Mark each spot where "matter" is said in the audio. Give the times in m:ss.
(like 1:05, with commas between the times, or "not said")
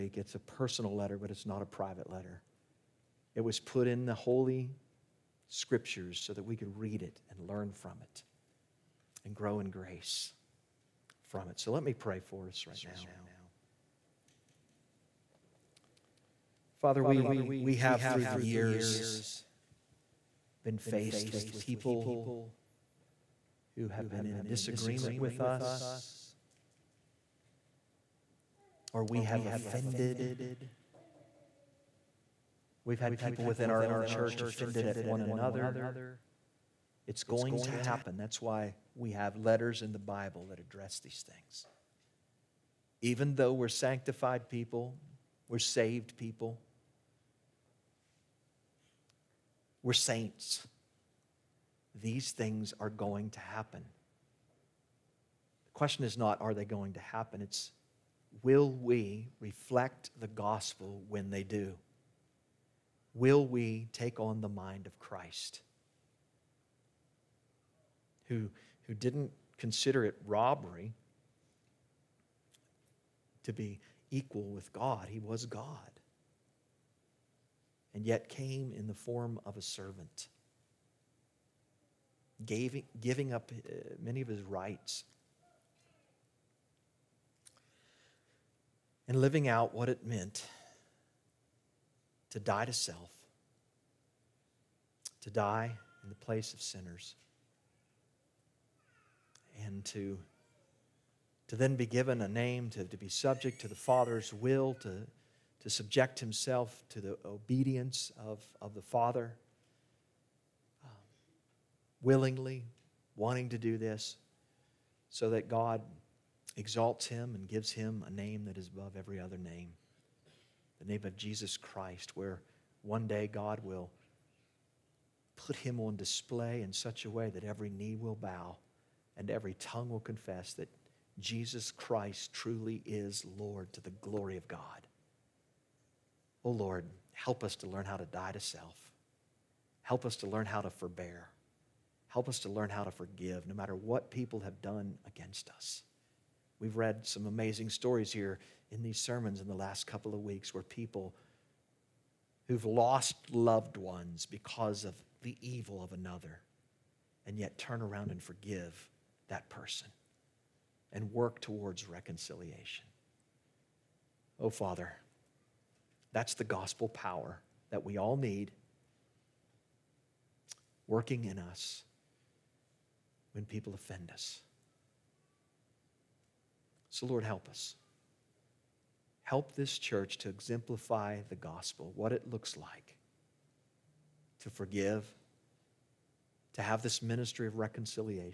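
2:23.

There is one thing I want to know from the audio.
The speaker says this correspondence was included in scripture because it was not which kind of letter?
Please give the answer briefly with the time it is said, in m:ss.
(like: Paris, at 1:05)
private letter, at 0:01.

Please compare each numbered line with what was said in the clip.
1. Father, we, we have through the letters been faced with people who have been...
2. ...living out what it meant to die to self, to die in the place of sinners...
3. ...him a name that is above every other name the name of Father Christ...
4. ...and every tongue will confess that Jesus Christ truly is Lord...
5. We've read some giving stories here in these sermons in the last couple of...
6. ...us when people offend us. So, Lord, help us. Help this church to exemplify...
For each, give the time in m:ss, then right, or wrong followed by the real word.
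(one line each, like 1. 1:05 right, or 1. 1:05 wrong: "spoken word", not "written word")
1. 0:16 wrong: "years", not "letters"
2. 1:29 right
3. 1:57 wrong: "Jesus", not "Father"
4. 2:09 right
5. 2:26 wrong: "amazing", not "giving"
6. 2:51 right.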